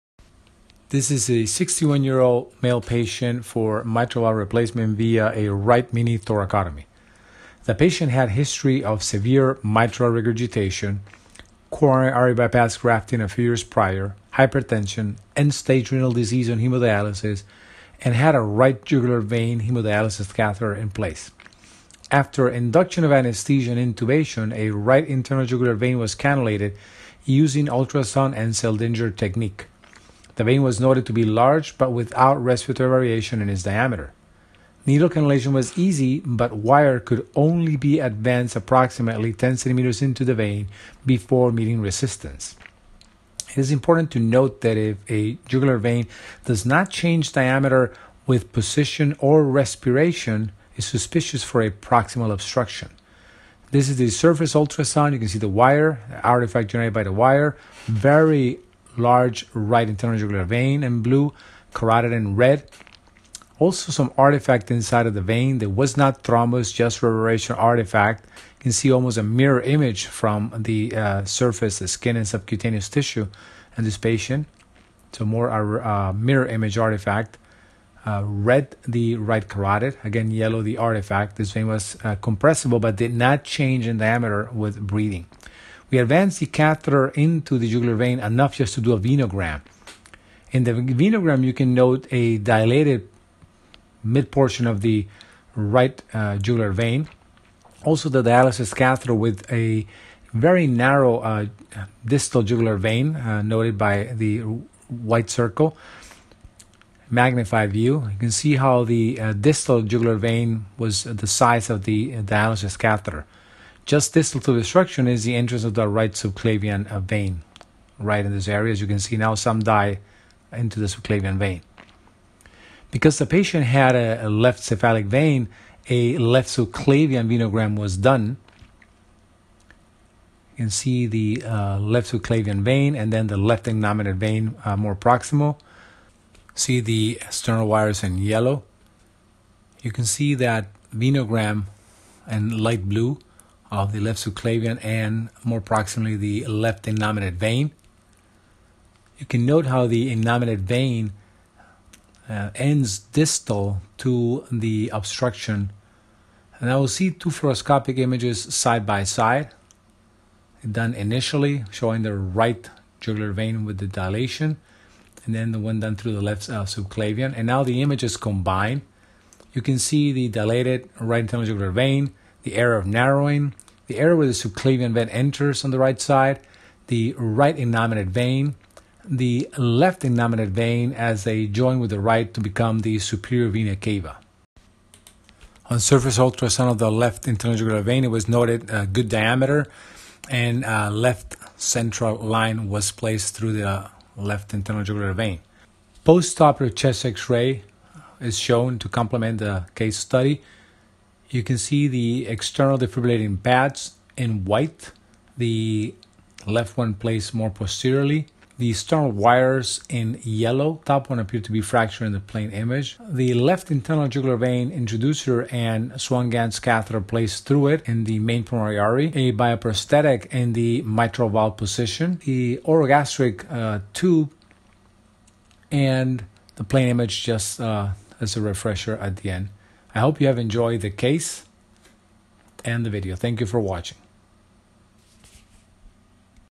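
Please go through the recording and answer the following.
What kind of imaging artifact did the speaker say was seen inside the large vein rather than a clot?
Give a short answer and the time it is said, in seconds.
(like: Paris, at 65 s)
Mirror image artifact, at 76 s.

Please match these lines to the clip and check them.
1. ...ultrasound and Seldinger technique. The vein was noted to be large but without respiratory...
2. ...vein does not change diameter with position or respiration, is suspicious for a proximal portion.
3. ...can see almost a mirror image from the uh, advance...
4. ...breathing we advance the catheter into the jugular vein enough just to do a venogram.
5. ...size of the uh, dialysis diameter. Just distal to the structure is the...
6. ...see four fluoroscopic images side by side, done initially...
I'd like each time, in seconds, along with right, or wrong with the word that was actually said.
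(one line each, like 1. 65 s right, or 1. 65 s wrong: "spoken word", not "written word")
1. 27 s right
2. 45 s wrong: "obstruction", not "portion"
3. 68 s wrong: "surface", not "advance"
4. 84 s right
5. 111 s wrong: "catheter", not "diameter"
6. 156 s wrong: "two", not "four".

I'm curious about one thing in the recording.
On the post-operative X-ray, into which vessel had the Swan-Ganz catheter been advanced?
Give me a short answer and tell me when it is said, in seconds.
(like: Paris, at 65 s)
Main pulmonary artery, at 218 s.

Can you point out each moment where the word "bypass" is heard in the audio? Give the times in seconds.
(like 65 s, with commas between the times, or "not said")
12 s.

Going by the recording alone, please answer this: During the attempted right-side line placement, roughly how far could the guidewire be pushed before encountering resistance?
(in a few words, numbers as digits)
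10 centimeters.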